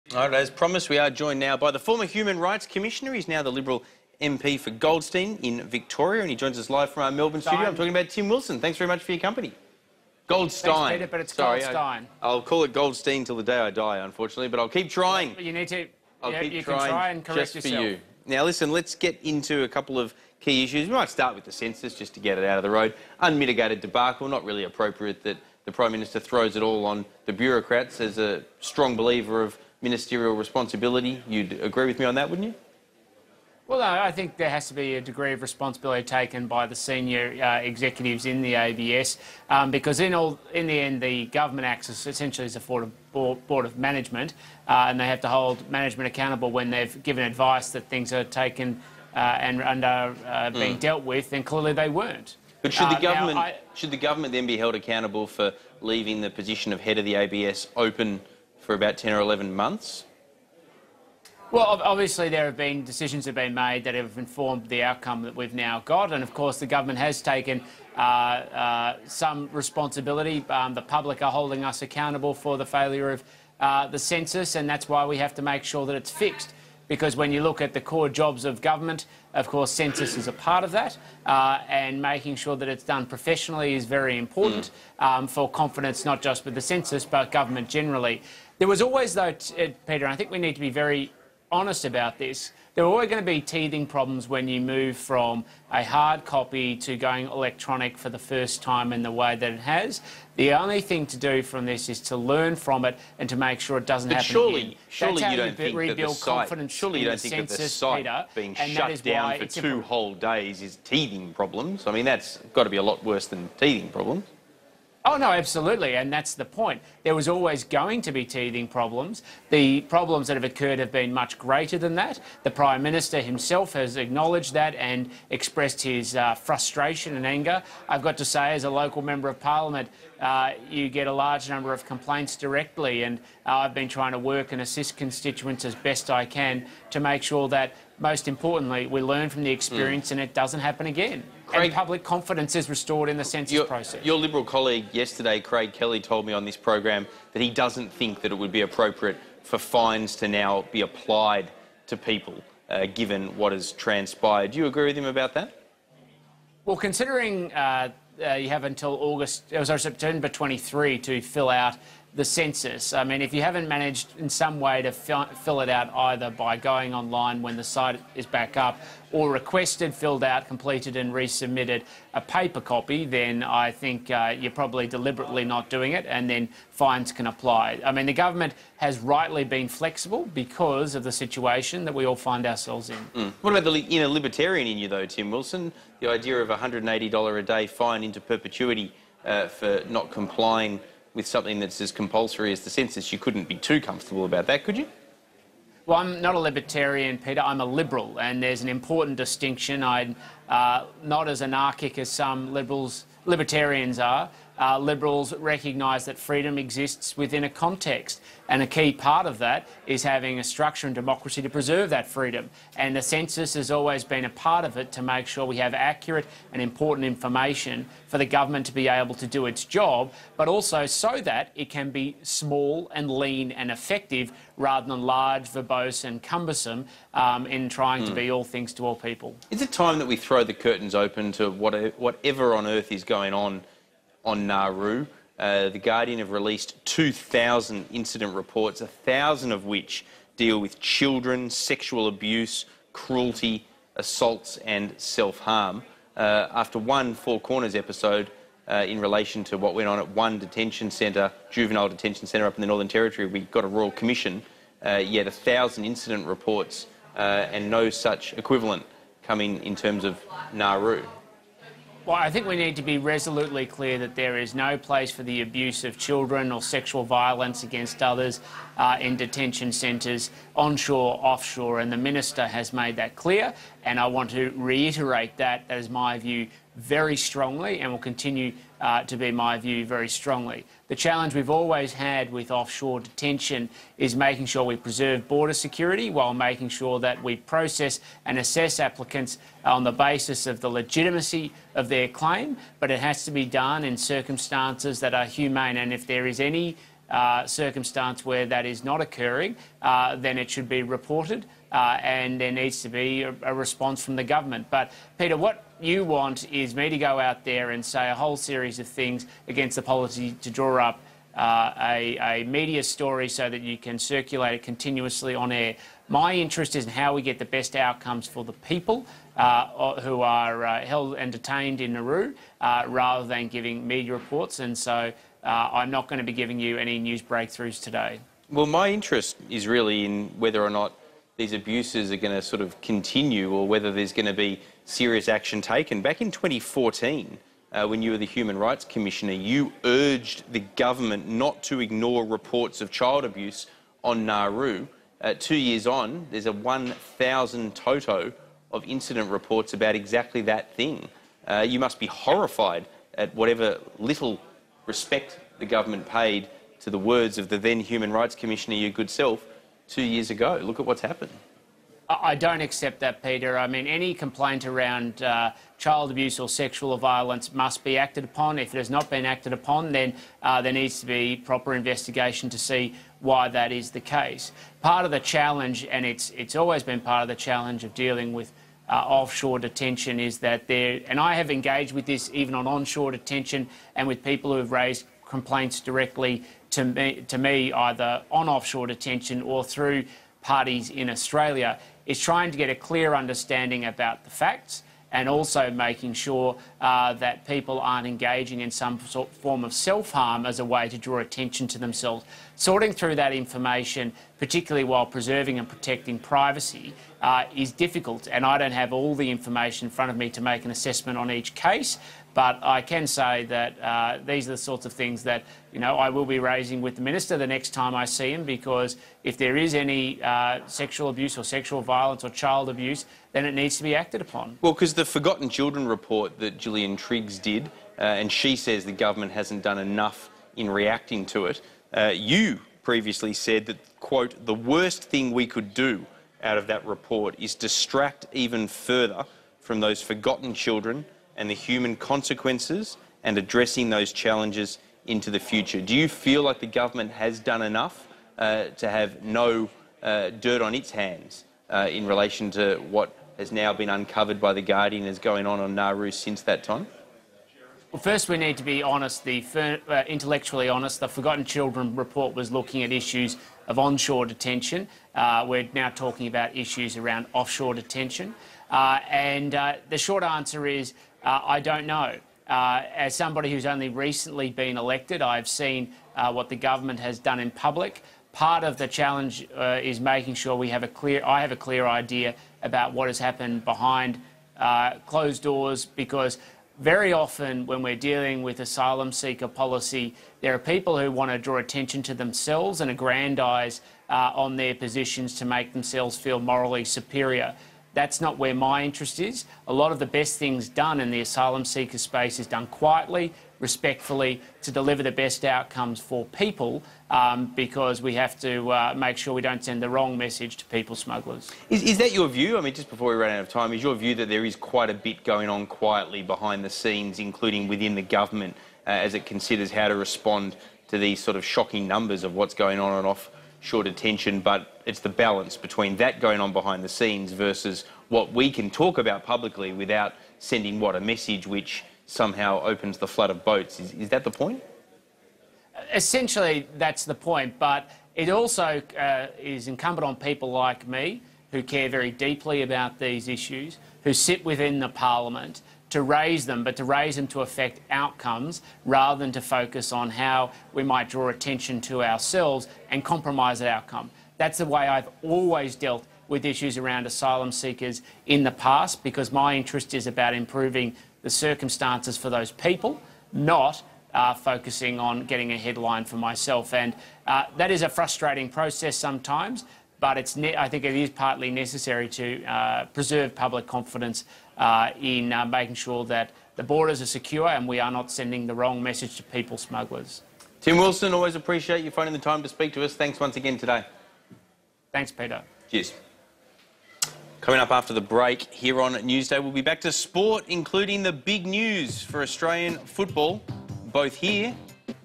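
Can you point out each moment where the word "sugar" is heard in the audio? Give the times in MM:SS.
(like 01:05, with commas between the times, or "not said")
not said.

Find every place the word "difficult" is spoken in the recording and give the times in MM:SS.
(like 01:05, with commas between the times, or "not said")
06:47.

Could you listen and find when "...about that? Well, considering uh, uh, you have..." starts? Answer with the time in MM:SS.
02:35.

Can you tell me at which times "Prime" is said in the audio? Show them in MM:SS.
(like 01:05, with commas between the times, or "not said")
00:25, 02:02.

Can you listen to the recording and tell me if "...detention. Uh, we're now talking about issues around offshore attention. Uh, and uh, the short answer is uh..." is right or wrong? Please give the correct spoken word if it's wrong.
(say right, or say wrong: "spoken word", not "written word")
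wrong: "detention", not "attention".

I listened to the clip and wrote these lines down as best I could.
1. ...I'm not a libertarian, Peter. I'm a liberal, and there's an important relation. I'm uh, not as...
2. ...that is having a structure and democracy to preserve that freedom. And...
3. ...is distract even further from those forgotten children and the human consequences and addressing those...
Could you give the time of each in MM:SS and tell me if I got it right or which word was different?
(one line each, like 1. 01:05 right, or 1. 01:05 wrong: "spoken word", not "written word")
1. 03:15 wrong: "distinction", not "relation"
2. 03:29 right
3. 07:17 right.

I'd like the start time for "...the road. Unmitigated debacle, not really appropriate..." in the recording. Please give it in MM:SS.
00:22.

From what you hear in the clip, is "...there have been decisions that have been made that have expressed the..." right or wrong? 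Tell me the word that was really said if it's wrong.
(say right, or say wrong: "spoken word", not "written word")
wrong: "informed", not "expressed".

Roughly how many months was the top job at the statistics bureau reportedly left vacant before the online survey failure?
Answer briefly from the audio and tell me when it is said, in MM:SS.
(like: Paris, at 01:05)
10 or 11 months, at 00:58.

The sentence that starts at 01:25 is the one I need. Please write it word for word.
um, for confidence, not just with the census, but government generally.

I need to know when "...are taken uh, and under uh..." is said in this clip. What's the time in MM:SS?
00:48.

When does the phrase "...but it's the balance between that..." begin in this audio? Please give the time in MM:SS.
08:44.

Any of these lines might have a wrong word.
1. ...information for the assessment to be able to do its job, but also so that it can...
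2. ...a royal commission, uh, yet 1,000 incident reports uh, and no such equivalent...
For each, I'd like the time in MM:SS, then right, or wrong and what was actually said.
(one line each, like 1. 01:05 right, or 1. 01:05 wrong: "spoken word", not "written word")
1. 03:37 wrong: "government", not "assessment"
2. 04:13 right.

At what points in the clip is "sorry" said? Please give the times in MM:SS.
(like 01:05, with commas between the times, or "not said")
00:11, 02:39.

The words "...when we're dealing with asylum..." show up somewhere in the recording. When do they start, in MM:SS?
08:07.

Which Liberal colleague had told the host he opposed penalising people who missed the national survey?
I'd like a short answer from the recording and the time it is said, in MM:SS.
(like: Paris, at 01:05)
Craig Kelly, at 02:25.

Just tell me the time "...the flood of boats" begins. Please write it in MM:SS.
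08:52.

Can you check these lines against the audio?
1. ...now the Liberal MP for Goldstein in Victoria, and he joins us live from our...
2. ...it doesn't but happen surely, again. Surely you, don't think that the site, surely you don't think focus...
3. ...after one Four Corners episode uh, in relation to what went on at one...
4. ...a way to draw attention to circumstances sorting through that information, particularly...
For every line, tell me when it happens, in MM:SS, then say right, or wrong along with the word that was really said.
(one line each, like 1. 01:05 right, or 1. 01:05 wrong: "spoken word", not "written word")
1. 00:03 right
2. 01:43 wrong: "census", not "focus"
3. 04:06 right
4. 06:40 wrong: "themselves", not "circumstances".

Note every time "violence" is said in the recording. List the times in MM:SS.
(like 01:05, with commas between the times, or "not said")
04:27, 06:06, 07:01.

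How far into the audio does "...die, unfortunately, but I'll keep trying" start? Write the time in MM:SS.
00:13.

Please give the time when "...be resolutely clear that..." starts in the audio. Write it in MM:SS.
04:22.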